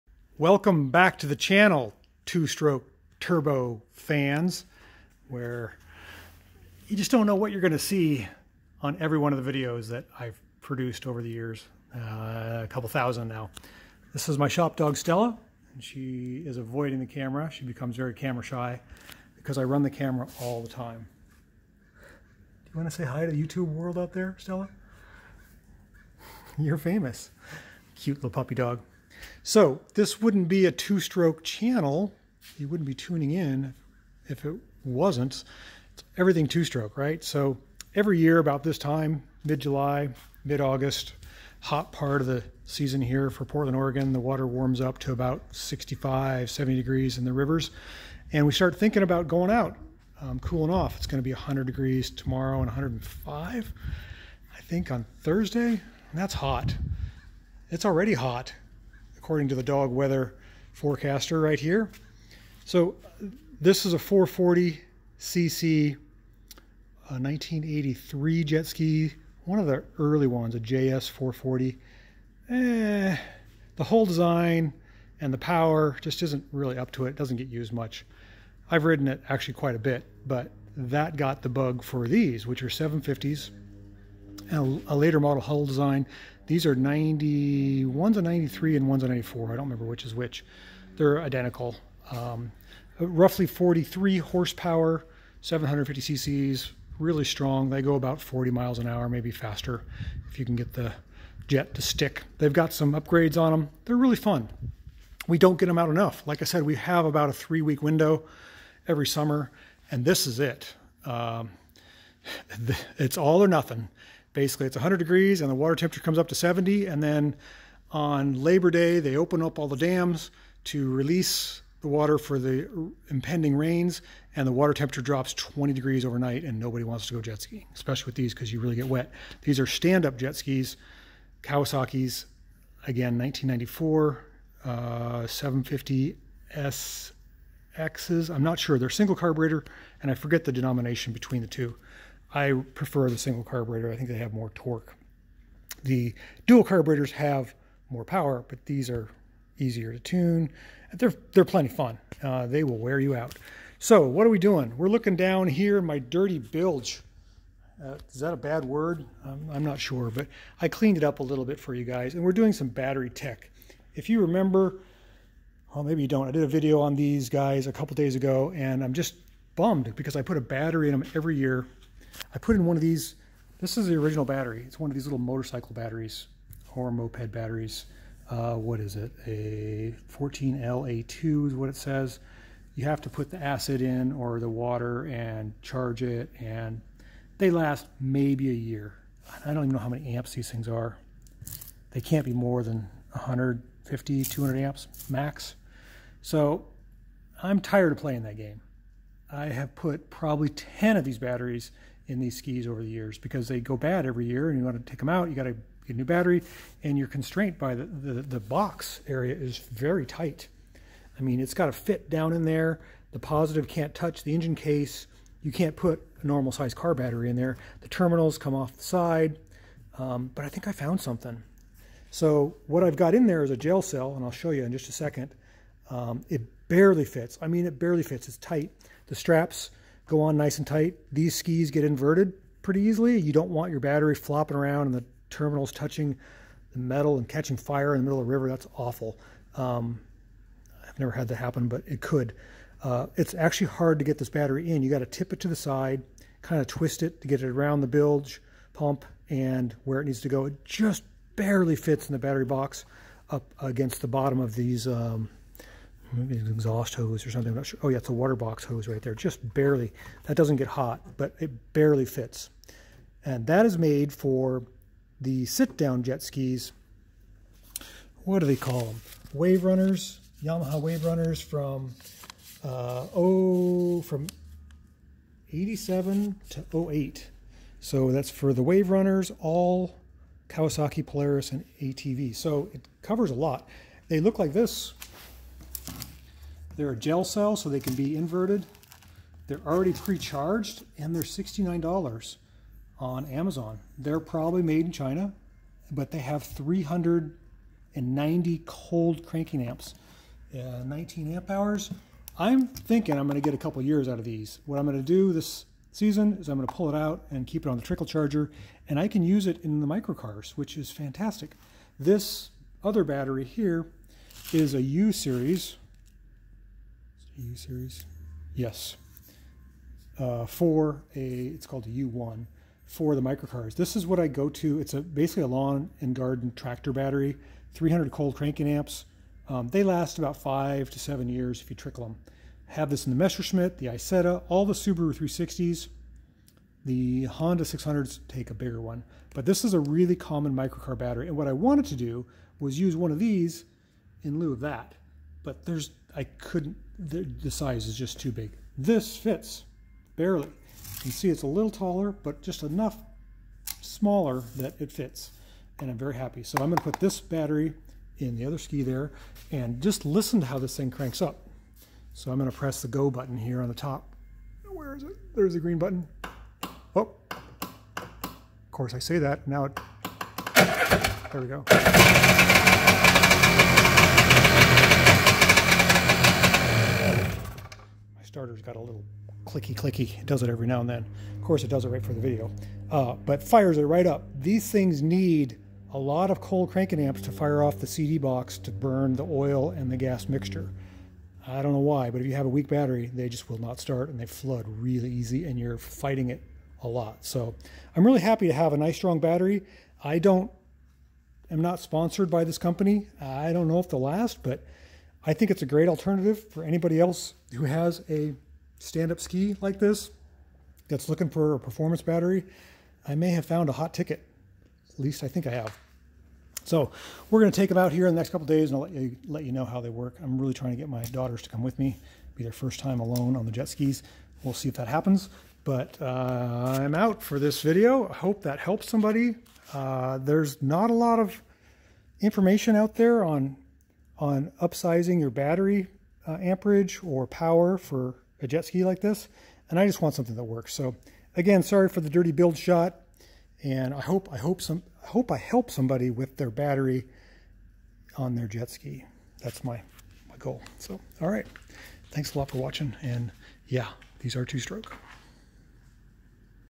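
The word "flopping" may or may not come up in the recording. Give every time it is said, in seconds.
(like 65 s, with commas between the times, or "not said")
234 s.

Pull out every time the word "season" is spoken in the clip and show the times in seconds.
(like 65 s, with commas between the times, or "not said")
42 s, 305 s.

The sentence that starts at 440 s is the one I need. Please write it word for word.
So again, sorry for the dirty bilge shot.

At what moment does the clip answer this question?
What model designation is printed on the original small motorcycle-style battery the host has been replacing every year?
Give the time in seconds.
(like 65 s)
180 s.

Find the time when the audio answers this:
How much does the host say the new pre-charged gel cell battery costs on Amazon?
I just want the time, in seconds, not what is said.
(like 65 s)
291 s.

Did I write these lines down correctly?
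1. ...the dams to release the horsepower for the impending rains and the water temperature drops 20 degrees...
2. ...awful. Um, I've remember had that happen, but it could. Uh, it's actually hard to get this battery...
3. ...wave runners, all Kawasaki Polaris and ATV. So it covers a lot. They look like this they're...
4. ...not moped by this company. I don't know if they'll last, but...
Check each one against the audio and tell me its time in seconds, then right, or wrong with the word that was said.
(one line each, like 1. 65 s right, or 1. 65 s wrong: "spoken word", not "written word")
1. 119 s wrong: "water", not "horsepower"
2. 238 s wrong: "never", not "remember"
3. 278 s right
4. 401 s wrong: "sponsored", not "moped".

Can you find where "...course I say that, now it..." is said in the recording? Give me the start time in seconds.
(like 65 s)
368 s.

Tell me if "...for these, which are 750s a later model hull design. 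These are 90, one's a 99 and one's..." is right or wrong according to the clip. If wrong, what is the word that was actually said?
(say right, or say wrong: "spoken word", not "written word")
wrong: "93", not "99".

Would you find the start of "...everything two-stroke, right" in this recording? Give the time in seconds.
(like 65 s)
36 s.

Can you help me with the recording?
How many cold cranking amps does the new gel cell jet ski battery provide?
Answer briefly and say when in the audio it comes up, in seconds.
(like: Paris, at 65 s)
390, at 296 s.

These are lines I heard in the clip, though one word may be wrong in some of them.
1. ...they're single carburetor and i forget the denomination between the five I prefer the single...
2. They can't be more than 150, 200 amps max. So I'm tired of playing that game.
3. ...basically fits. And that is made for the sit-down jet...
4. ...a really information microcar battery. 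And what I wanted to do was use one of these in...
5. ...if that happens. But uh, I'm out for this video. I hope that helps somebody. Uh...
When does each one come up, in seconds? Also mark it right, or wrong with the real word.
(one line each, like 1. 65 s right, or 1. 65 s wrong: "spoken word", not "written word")
1. 138 s wrong: "two", not "five"
2. 191 s right
3. 261 s wrong: "barely", not "basically"
4. 339 s wrong: "common", not "information"
5. 424 s right.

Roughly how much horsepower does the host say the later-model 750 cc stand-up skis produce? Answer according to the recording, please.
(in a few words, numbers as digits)
43.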